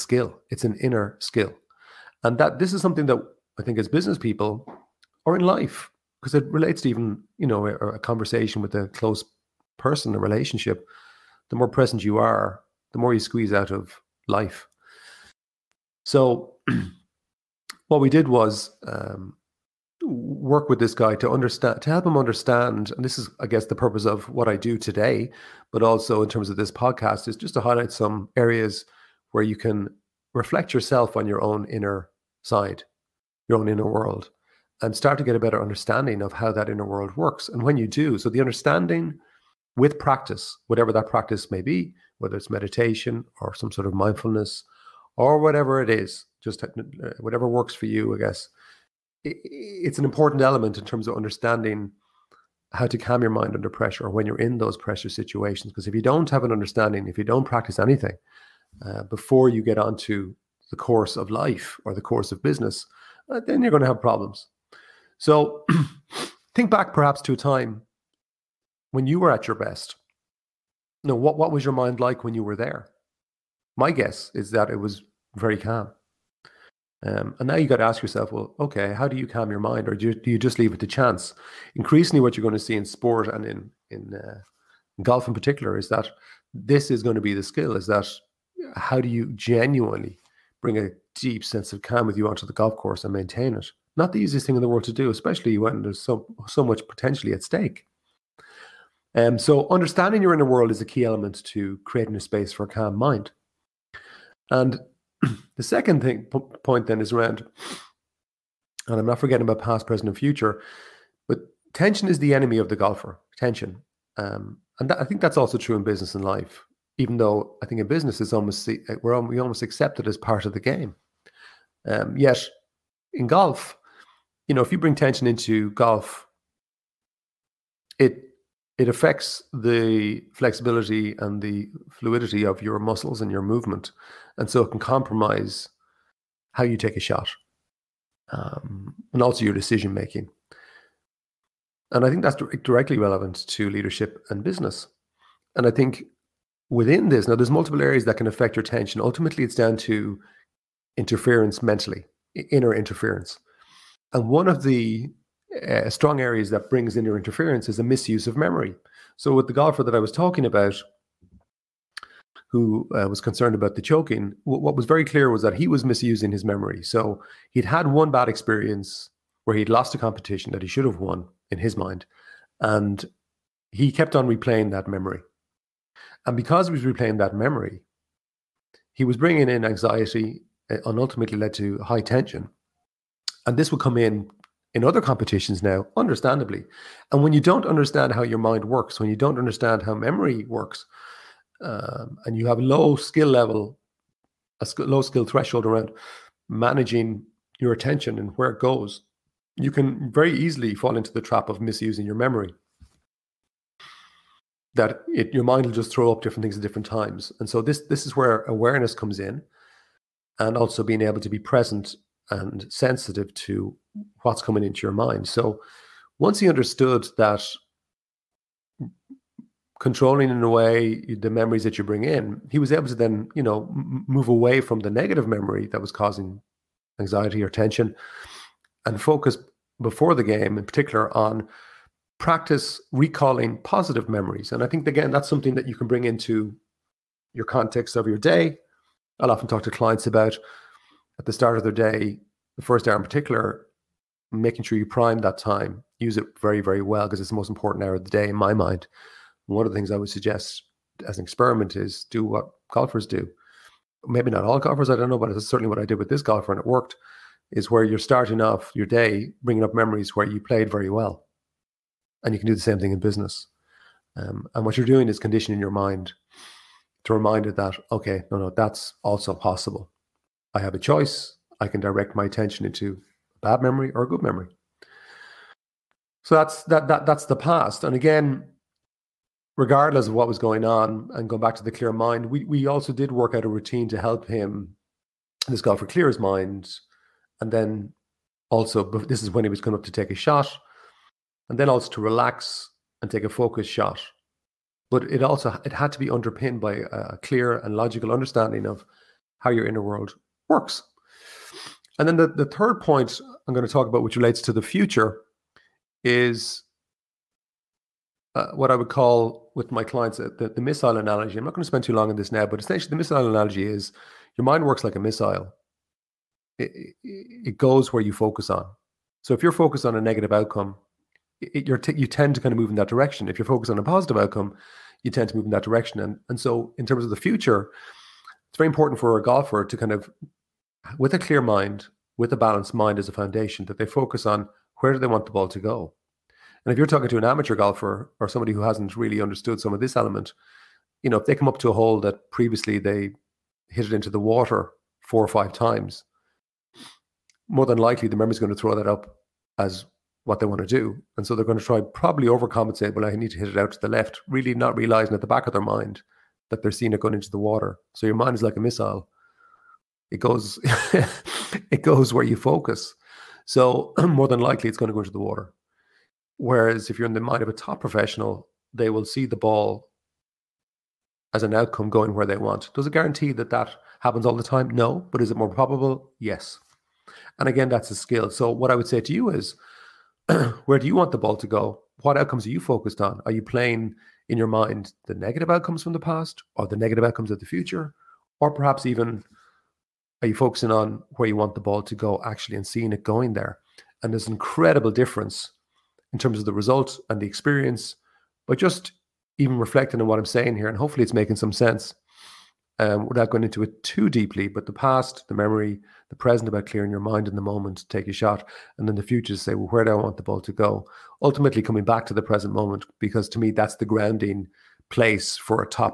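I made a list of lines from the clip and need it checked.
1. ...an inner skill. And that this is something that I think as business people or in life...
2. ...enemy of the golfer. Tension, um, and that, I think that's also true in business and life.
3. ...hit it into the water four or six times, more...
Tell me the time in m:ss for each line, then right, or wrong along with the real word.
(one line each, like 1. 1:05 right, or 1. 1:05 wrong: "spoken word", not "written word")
1. 0:00 right
2. 1:52 right
3. 5:43 wrong: "five", not "six".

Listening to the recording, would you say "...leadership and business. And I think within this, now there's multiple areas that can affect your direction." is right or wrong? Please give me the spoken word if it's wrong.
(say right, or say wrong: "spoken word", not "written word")
wrong: "attention", not "direction".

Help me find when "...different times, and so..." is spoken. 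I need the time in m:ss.
3:26.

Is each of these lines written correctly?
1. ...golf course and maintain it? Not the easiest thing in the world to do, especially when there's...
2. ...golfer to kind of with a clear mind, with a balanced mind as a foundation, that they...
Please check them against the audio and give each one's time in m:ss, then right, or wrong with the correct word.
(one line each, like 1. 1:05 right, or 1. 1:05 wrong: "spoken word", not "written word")
1. 1:32 right
2. 5:29 right.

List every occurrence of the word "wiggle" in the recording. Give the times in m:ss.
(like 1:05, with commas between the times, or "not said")
not said.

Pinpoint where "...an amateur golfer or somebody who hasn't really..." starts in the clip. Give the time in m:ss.
5:37.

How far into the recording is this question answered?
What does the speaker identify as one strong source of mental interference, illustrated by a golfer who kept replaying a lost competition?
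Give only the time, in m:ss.
2:37.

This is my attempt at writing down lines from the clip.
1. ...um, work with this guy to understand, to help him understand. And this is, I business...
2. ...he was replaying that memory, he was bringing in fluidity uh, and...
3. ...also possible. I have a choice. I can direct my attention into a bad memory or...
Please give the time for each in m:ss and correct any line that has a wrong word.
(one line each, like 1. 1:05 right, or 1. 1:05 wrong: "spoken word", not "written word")
1. 0:18 wrong: "guess", not "business"
2. 2:56 wrong: "anxiety", not "fluidity"
3. 4:29 right.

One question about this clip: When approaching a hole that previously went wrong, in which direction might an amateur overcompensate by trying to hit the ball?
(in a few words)
Out to the left.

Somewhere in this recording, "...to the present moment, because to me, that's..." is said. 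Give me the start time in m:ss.
6:52.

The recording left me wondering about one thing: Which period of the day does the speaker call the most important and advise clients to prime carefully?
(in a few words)
The first hour.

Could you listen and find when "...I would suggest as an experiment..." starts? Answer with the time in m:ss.
4:09.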